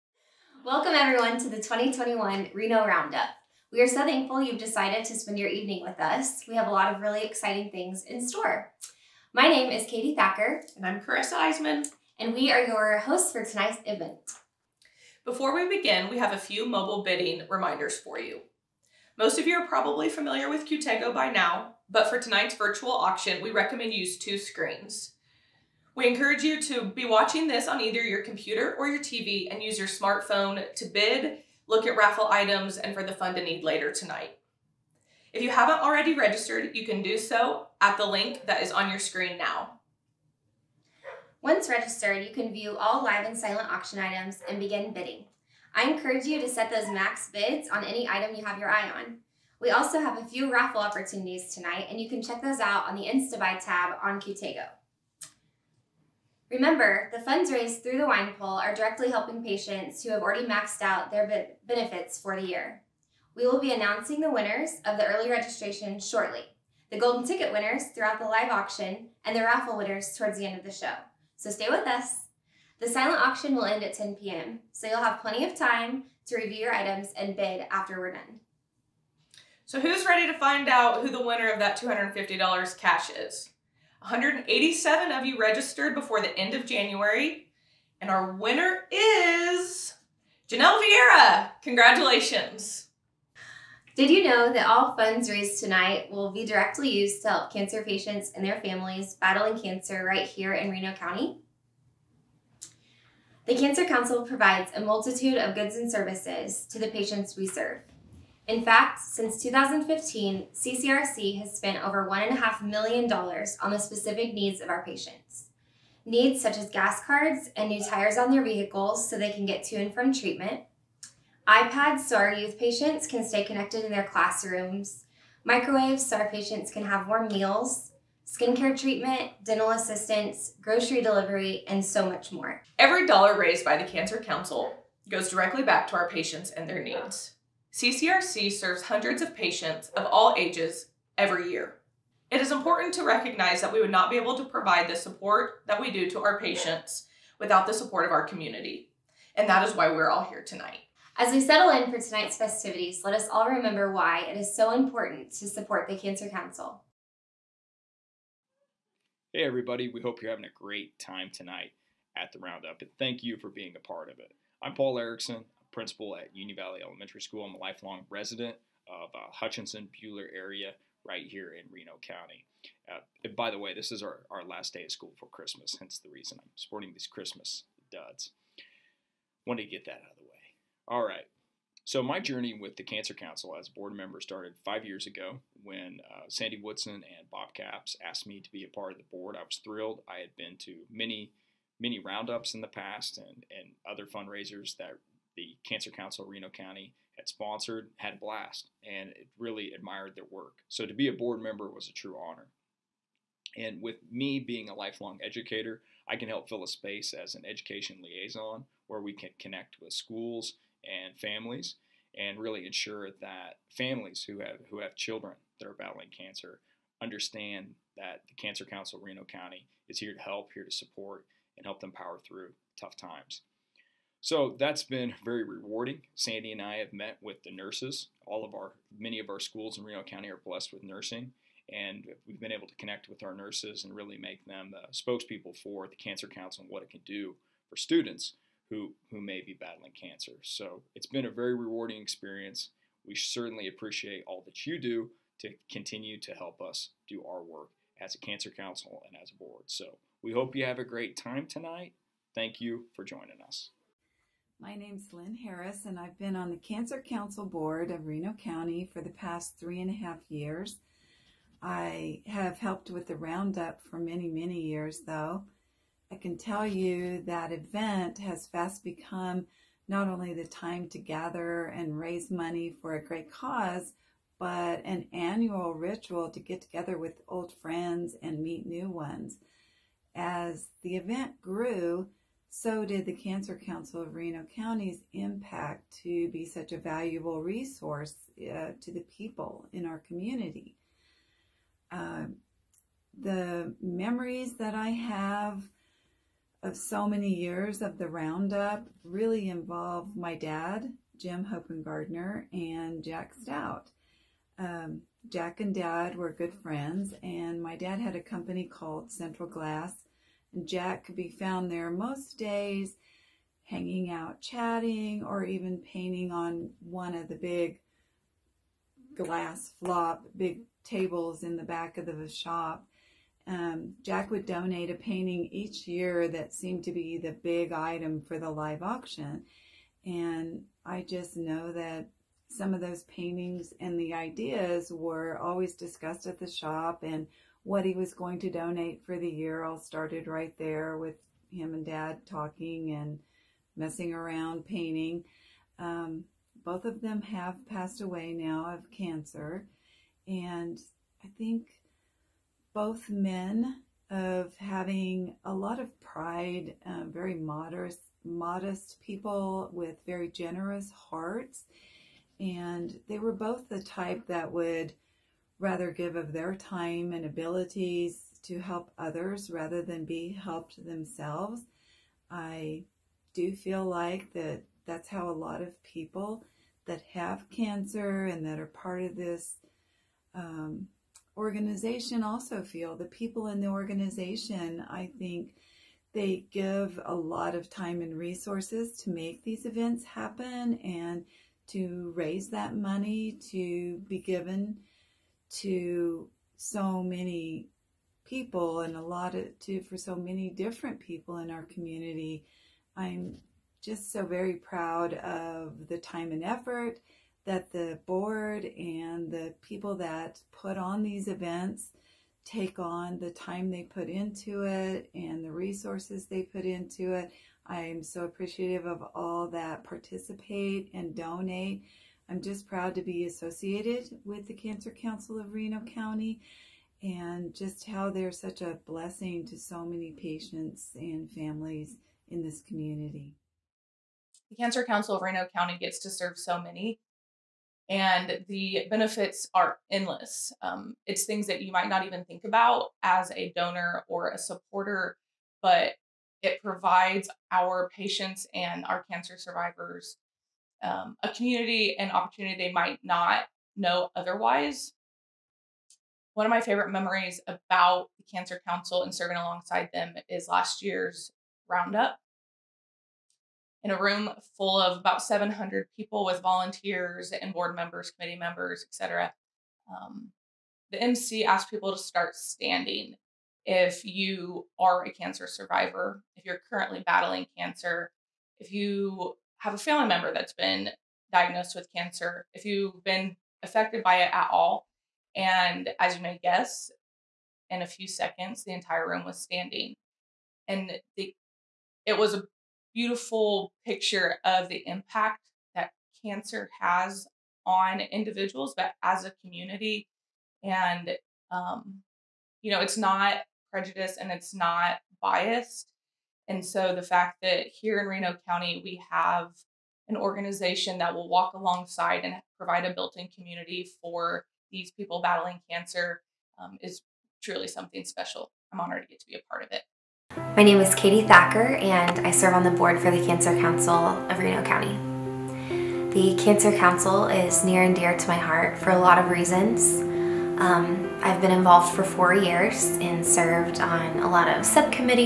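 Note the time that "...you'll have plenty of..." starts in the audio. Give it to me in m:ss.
1:14.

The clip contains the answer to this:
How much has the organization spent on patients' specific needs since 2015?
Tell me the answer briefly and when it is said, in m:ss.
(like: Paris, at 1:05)
$1.5 million, at 1:52.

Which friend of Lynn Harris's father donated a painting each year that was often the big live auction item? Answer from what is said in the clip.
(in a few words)
Jack Stout.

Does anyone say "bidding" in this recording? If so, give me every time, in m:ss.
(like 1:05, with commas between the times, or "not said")
0:17, 0:44.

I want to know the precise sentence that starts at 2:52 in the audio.
Uh, by the way, this is our, our last day of school for Christmas, hence the reason I'm sporting these Christmas duds.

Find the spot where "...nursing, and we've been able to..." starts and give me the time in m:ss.
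3:50.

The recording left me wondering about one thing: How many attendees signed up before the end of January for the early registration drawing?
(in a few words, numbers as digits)
187.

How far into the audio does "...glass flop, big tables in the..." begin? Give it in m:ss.
5:19.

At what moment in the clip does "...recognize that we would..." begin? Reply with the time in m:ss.
2:23.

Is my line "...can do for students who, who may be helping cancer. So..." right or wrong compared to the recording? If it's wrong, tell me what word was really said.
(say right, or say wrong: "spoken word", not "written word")
wrong: "battling", not "helping".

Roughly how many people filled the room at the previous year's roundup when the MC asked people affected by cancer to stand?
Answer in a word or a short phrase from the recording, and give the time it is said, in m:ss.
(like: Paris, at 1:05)
700, at 7:45.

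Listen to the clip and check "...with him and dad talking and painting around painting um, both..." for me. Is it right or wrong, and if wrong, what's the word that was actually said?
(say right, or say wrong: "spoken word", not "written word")
wrong: "messing", not "painting".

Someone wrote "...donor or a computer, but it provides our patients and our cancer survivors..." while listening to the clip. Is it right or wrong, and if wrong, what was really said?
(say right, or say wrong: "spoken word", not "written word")
wrong: "supporter", not "computer".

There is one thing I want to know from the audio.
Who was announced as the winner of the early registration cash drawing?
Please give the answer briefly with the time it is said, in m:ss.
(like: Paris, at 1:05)
Janelle Vieira, at 1:30.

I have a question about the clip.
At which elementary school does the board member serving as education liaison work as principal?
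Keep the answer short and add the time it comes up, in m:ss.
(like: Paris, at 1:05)
Union Valley Elementary, at 2:46.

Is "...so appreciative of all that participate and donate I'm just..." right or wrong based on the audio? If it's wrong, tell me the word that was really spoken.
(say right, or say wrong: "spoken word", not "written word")
right.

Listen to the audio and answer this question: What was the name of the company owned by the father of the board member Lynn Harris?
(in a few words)
Central Glass.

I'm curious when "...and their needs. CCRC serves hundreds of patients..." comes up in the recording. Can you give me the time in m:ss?
2:16.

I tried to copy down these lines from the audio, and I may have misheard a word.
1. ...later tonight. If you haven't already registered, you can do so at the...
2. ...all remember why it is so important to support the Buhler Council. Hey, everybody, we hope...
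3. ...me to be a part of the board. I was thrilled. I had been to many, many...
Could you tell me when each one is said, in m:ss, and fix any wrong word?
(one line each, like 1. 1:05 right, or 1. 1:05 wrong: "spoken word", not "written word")
1. 0:33 right
2. 2:33 wrong: "Cancer", not "Buhler"
3. 3:08 right.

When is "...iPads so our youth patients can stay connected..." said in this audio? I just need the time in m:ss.
2:01.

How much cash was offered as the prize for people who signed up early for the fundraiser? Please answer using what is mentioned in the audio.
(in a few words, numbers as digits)
$250.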